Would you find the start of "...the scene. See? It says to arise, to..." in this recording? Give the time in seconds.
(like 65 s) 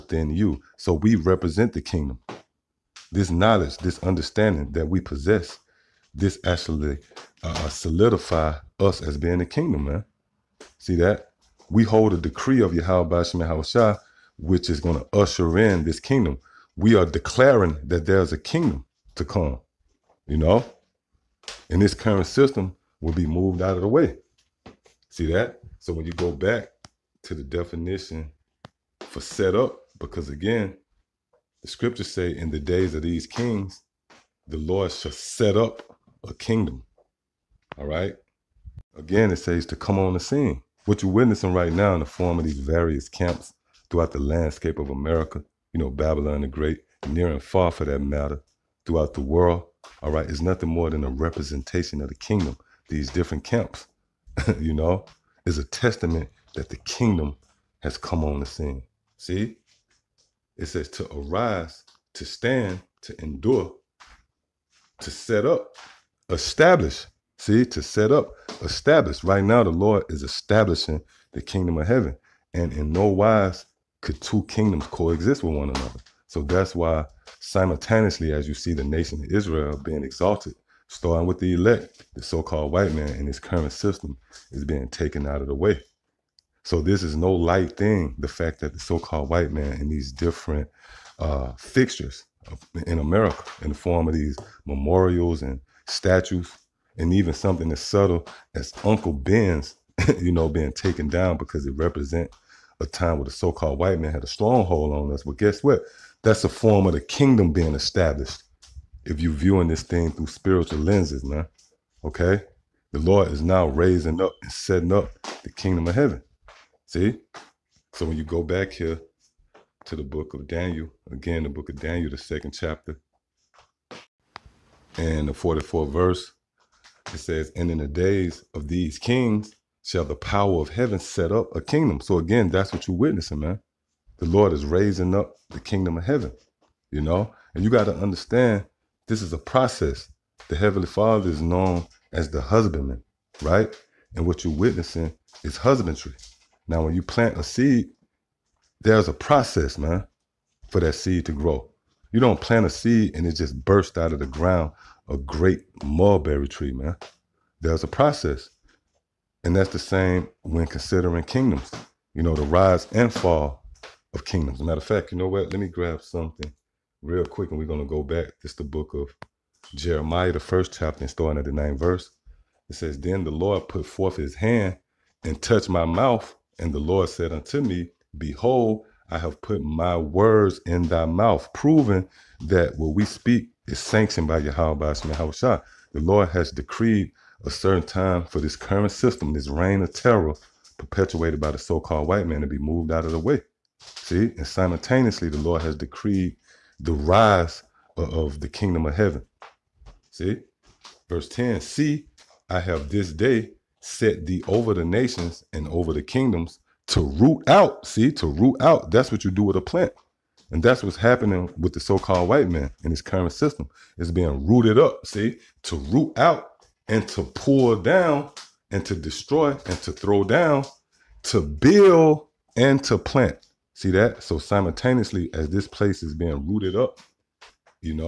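58 s.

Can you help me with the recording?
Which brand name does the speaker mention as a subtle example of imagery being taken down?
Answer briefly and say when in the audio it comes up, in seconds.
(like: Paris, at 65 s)
Uncle Ben's, at 98 s.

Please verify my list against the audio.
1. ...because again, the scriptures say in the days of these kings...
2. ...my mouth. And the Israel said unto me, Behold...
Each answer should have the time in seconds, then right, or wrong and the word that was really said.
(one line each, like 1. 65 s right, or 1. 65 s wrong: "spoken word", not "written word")
1. 29 s right
2. 175 s wrong: "Lord", not "Israel".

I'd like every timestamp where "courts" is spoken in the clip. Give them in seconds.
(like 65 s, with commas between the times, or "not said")
not said.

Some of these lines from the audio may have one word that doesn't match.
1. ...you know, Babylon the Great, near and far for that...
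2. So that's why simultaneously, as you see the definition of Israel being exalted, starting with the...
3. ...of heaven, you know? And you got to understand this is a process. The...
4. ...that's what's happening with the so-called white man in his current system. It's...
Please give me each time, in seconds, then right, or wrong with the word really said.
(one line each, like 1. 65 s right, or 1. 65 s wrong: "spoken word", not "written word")
1. 45 s right
2. 76 s wrong: "nation", not "definition"
3. 135 s right
4. 210 s right.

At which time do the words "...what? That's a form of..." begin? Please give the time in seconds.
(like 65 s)
105 s.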